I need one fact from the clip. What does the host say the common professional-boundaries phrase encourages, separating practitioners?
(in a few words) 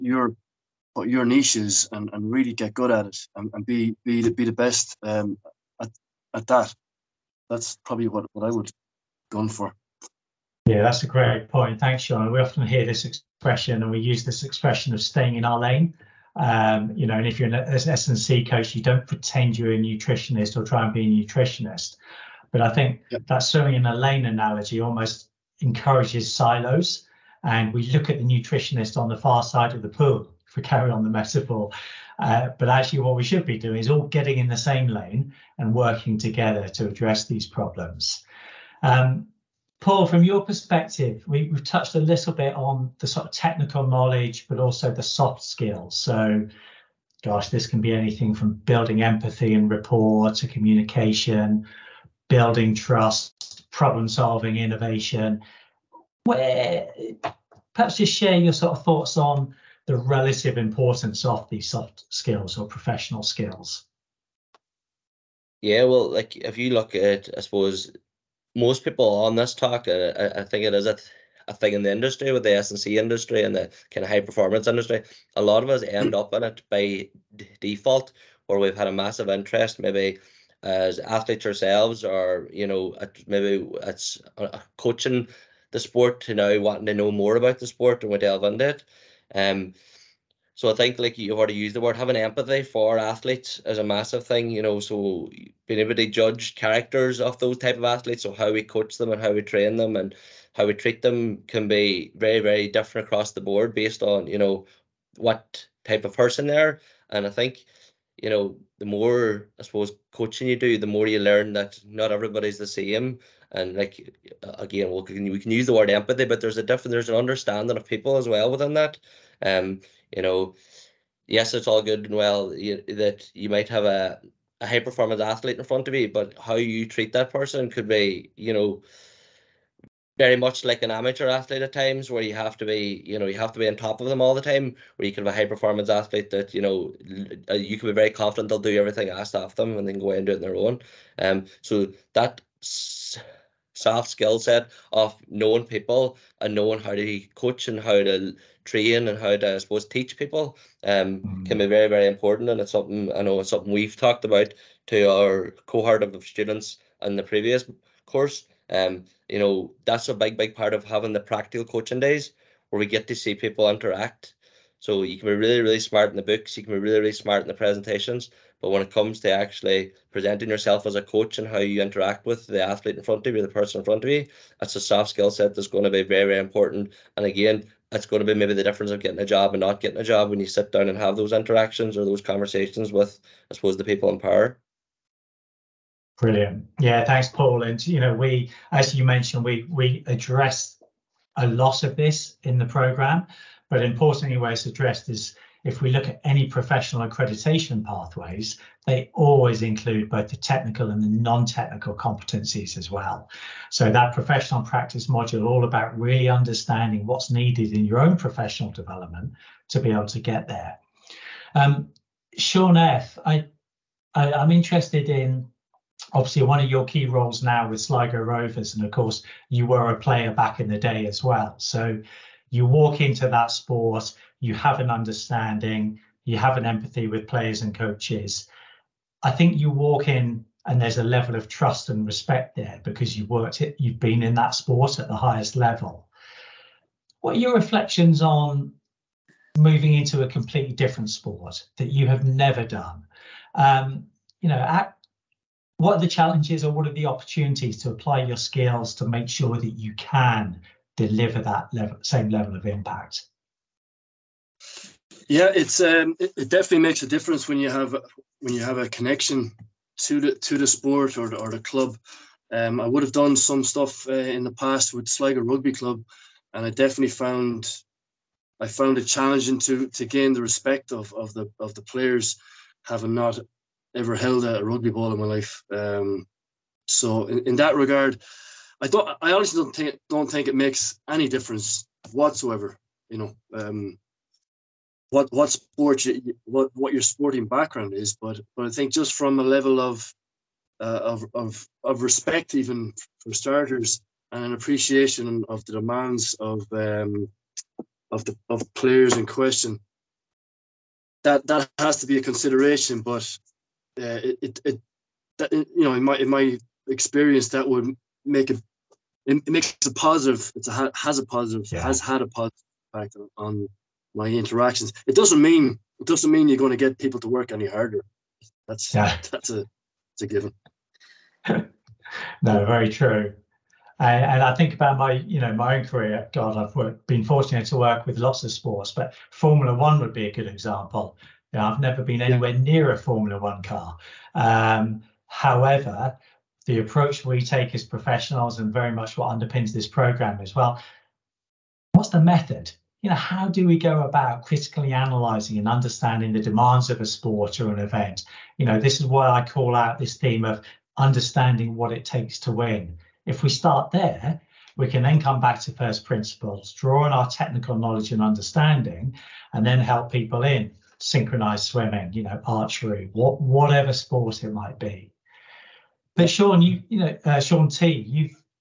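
silos.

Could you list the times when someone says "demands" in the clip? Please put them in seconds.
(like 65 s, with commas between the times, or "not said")
295 s, 346 s.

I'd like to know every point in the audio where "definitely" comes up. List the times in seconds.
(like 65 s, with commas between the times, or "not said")
256 s, 266 s.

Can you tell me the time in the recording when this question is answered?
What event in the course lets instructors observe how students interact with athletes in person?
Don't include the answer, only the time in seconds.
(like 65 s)
161 s.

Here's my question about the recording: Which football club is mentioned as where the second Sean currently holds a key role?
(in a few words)
Sligo Rovers.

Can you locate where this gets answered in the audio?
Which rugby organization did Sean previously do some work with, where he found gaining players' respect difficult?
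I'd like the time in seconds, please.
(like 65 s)
265 s.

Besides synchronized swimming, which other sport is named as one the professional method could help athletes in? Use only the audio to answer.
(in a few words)
archery.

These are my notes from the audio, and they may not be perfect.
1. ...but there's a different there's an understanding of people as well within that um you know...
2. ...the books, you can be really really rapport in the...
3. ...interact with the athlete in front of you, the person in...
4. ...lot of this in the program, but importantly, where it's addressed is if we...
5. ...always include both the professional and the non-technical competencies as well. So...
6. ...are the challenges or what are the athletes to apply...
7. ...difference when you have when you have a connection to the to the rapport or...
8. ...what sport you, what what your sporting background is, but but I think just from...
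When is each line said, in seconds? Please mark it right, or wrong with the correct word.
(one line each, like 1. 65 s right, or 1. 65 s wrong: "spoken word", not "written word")
1. 116 s right
2. 166 s wrong: "smart", not "rapport"
3. 171 s right
4. 191 s right
5. 199 s wrong: "technical", not "professional"
6. 245 s wrong: "opportunities", not "athletes"
7. 257 s wrong: "sport", not "rapport"
8. 285 s right.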